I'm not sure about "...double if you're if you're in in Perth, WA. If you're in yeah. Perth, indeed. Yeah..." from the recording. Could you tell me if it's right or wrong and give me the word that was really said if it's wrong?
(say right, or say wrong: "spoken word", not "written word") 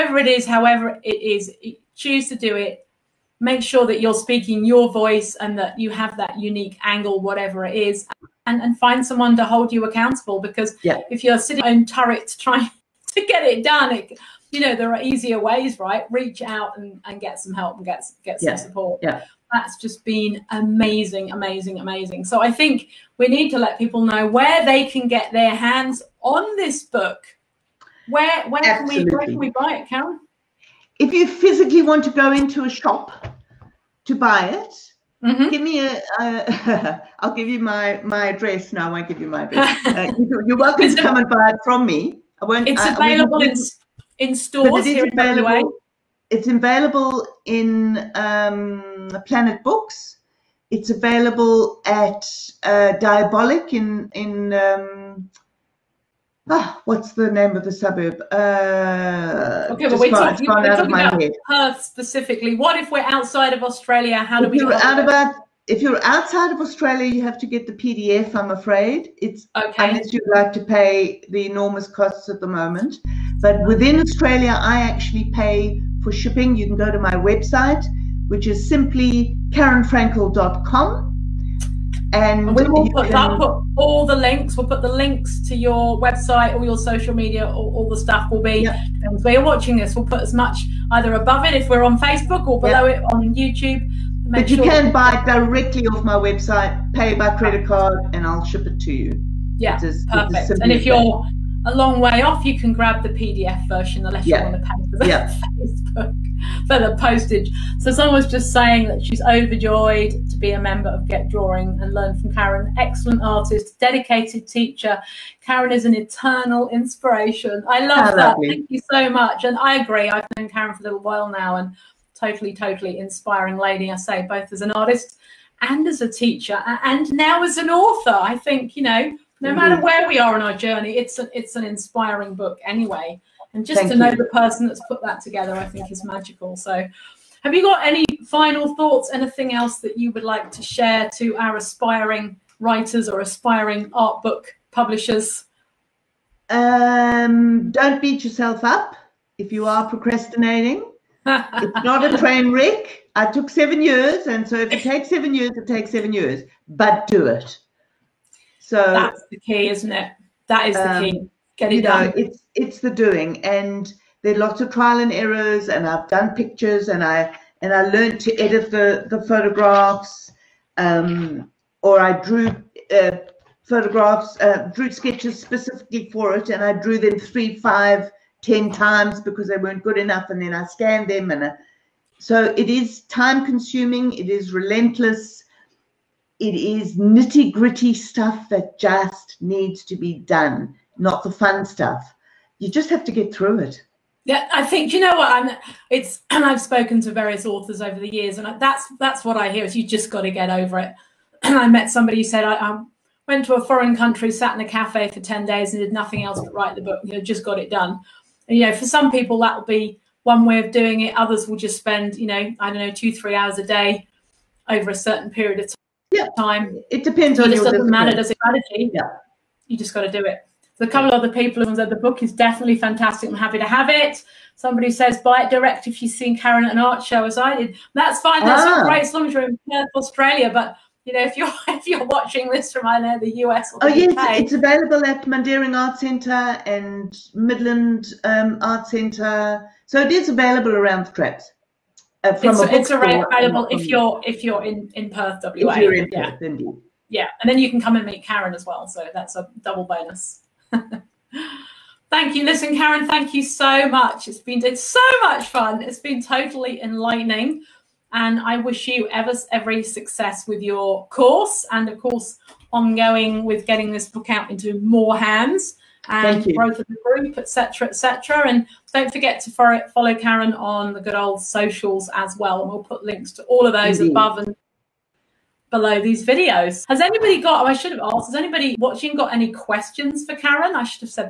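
wrong: "available", not "double".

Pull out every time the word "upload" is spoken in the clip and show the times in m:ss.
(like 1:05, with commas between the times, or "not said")
not said.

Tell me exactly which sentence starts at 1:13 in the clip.
But within Australia, I actually pay for shipping.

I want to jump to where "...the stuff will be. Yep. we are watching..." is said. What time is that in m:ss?
1:27.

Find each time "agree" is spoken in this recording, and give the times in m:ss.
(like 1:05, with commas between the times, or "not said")
1:59.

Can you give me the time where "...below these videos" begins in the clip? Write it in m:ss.
4:35.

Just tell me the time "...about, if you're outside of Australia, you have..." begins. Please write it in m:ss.
1:04.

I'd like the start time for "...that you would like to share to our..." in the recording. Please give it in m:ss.
2:19.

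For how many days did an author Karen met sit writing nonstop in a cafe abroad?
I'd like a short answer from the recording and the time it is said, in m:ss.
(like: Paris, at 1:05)
10, at 3:25.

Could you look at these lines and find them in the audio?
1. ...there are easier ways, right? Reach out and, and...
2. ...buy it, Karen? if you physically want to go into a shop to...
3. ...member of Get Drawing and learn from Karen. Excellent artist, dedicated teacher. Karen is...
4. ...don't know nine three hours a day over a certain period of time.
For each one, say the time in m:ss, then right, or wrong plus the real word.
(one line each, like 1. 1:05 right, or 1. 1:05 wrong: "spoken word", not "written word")
1. 0:14 right
2. 0:29 right
3. 1:50 right
4. 3:32 wrong: "two", not "nine".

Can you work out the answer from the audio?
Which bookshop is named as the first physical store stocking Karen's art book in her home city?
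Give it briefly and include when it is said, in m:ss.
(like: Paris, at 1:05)
Planet Books, at 0:49.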